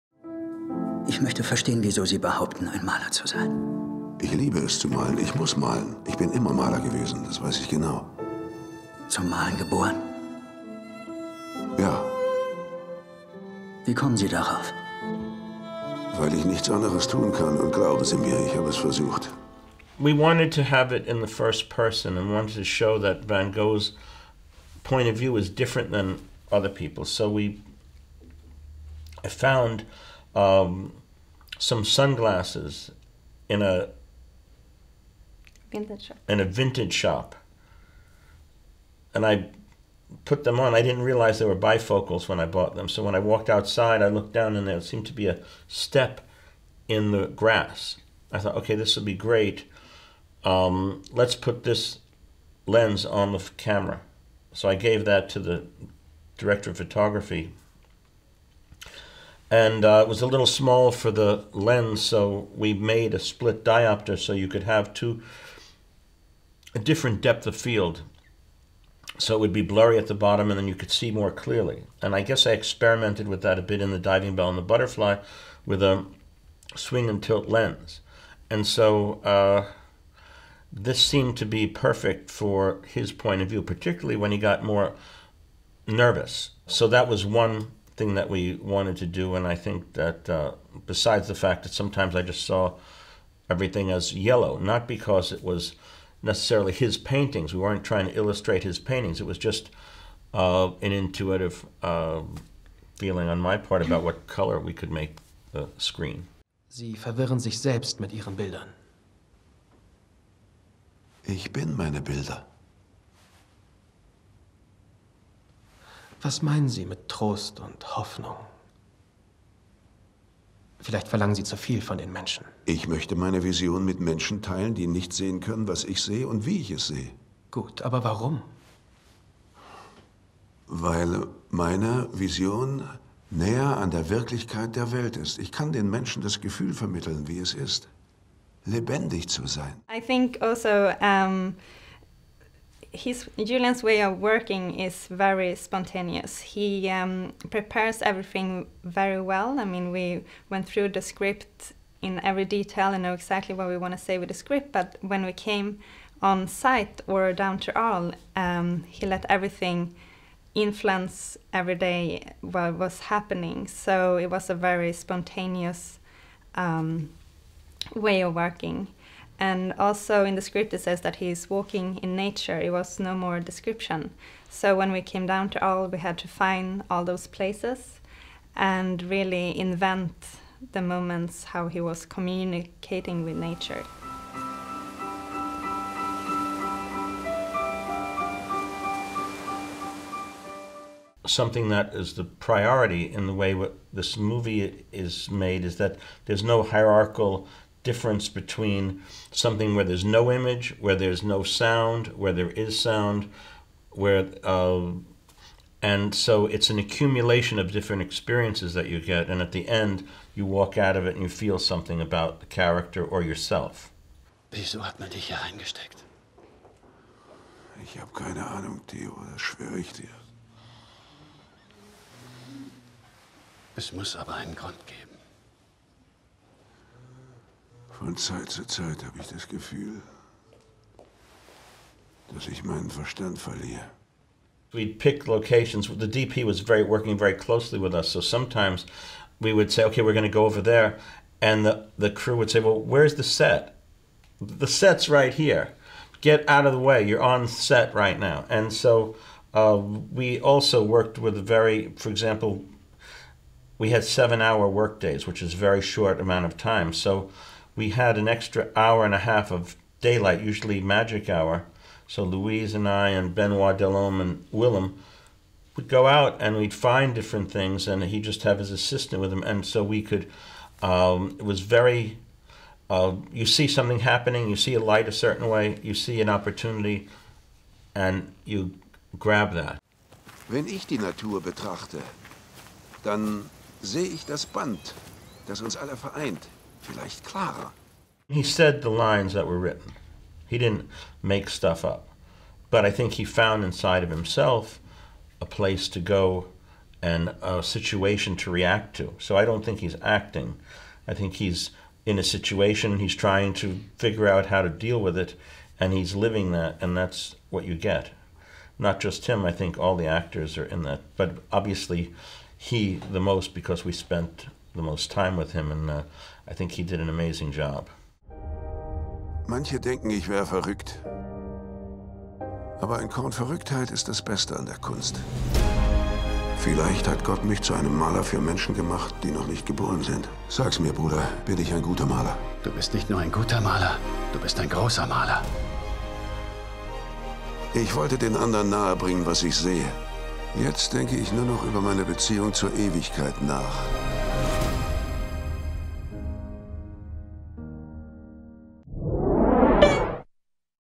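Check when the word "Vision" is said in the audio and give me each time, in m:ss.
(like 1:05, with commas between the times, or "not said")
2:03, 2:12.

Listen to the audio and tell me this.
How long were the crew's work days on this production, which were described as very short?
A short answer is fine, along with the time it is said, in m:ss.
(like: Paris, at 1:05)
7 hours, at 4:14.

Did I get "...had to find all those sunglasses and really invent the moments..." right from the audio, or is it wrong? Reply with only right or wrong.
wrong.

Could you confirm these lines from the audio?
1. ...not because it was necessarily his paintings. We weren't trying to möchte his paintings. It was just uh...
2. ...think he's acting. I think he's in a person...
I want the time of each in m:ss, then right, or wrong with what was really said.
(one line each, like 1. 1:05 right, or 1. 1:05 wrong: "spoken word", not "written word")
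1. 1:34 wrong: "illustrate", not "möchte"
2. 4:59 wrong: "situation", not "person".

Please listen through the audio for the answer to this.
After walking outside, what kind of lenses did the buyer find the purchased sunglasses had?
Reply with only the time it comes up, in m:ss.
0:41.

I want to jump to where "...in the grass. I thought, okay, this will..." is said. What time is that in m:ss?
0:46.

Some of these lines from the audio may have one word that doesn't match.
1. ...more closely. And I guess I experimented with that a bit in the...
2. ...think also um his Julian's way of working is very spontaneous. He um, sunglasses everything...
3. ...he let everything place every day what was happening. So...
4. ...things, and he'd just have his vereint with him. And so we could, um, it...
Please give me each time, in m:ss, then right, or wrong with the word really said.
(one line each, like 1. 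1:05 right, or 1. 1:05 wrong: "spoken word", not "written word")
1. 1:11 wrong: "clearly", not "closely"
2. 2:19 wrong: "prepares", not "sunglasses"
3. 2:38 wrong: "influence", not "place"
4. 4:27 wrong: "assistant", not "vereint".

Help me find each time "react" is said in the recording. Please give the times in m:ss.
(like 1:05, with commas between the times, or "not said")
4:58.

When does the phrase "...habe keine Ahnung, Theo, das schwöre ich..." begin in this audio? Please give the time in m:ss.
3:37.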